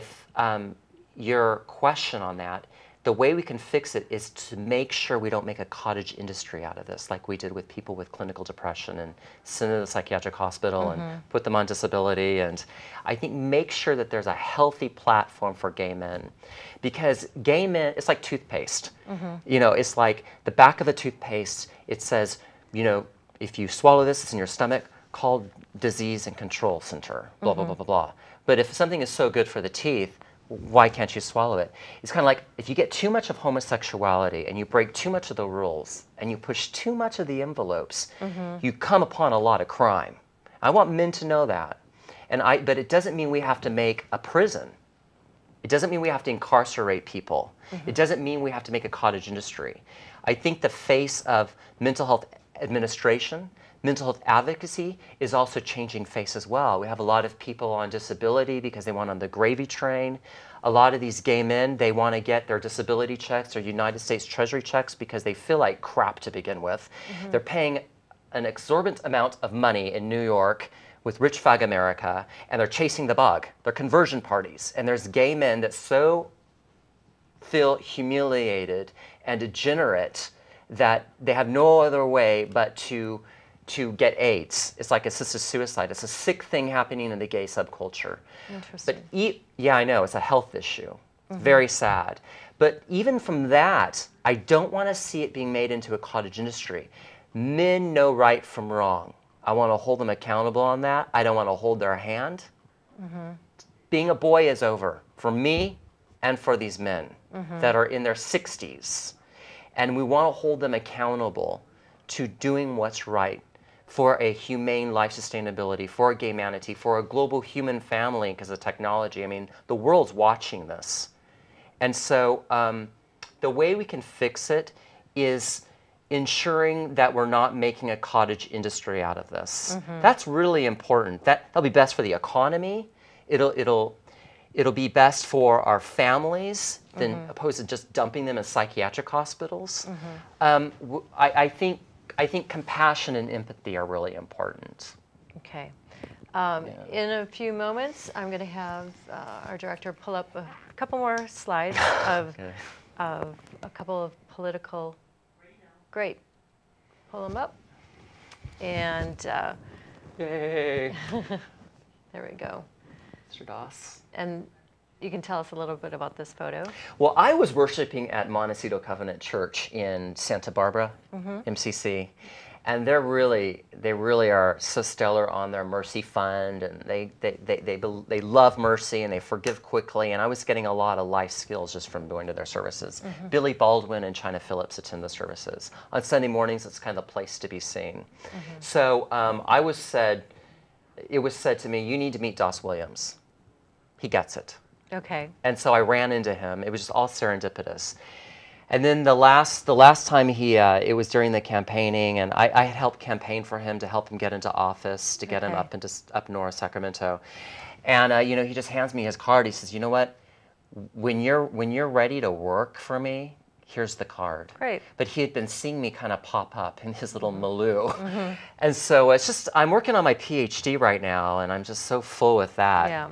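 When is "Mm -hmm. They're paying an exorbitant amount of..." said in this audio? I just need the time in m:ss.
1:06.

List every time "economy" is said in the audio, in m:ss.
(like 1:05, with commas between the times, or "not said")
2:12.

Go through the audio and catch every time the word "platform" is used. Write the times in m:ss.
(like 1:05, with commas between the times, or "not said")
0:14.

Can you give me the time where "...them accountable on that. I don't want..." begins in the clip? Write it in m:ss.
1:39.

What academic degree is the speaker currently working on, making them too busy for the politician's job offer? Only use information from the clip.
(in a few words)
PhD.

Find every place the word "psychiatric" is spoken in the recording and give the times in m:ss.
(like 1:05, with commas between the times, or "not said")
0:09, 2:18.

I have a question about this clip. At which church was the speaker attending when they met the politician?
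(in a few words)
Montecito Covenant Church.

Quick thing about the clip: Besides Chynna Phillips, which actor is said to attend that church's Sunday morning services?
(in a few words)
Billy Baldwin.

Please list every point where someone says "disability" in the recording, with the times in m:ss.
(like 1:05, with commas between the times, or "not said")
0:11, 0:57, 1:02.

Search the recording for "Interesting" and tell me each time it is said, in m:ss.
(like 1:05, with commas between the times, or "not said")
1:28.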